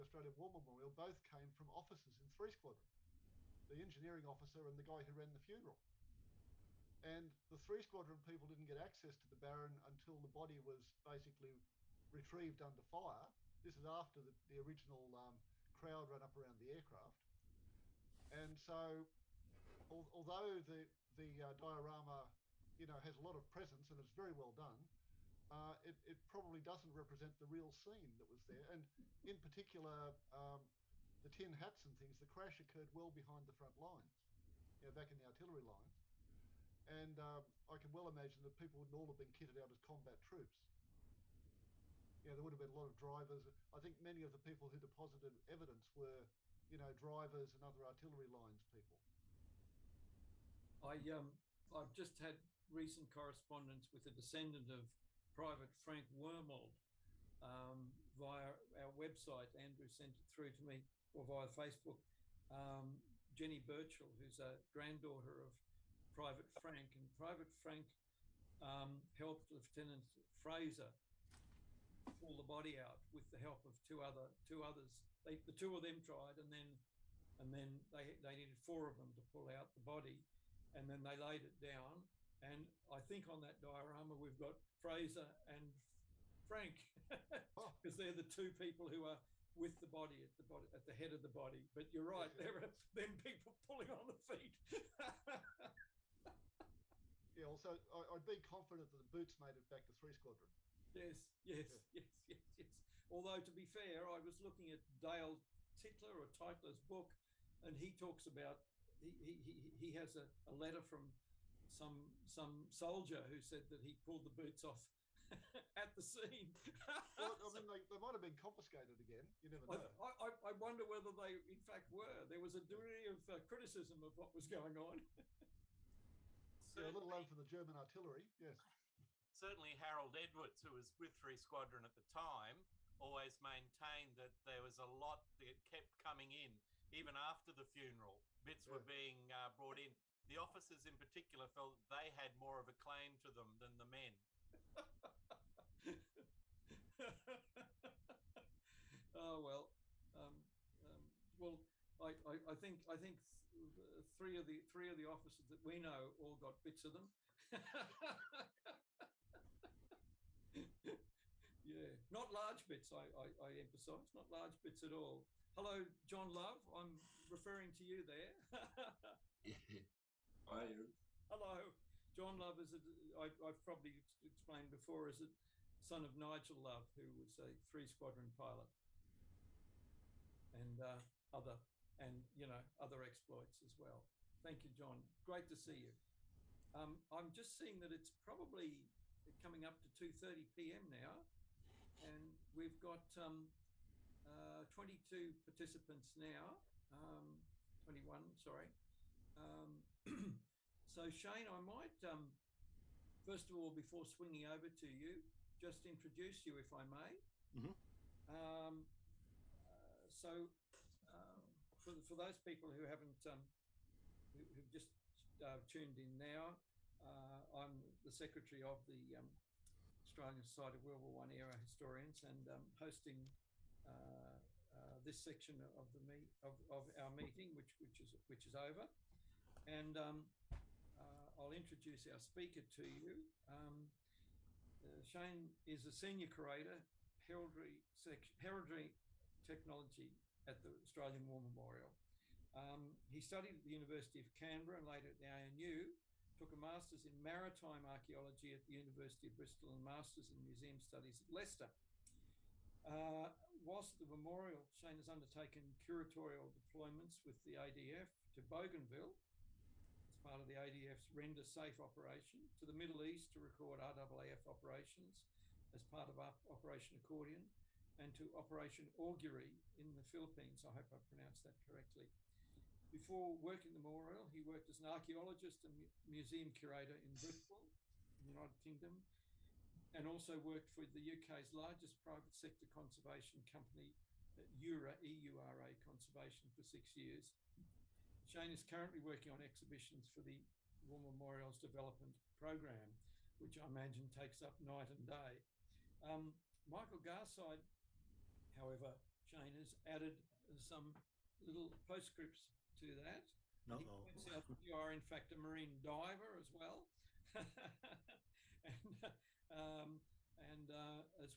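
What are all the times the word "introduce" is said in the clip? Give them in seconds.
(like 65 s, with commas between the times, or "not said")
205 s, 231 s.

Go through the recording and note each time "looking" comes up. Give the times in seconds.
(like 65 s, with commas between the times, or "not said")
104 s.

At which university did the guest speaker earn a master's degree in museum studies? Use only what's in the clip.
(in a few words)
Leicester.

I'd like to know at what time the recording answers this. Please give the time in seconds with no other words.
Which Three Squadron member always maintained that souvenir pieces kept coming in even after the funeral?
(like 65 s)
129 s.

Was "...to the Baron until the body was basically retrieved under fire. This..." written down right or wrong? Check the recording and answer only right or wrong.
right.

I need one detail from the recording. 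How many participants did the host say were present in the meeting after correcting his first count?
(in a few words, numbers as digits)
21.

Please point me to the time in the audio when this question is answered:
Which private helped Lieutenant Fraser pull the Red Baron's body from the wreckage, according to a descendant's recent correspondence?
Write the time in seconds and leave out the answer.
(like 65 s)
55 s.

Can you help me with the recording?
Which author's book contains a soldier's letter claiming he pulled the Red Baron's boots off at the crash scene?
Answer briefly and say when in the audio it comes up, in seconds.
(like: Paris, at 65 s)
Dale Titler, at 104 s.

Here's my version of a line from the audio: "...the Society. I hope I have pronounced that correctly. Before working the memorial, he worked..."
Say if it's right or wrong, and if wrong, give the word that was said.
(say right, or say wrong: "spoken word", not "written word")
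wrong: "Philippines", not "Society".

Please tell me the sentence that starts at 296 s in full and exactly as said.
Um, Michael Garside, however, Shane has added some little postscripts to that.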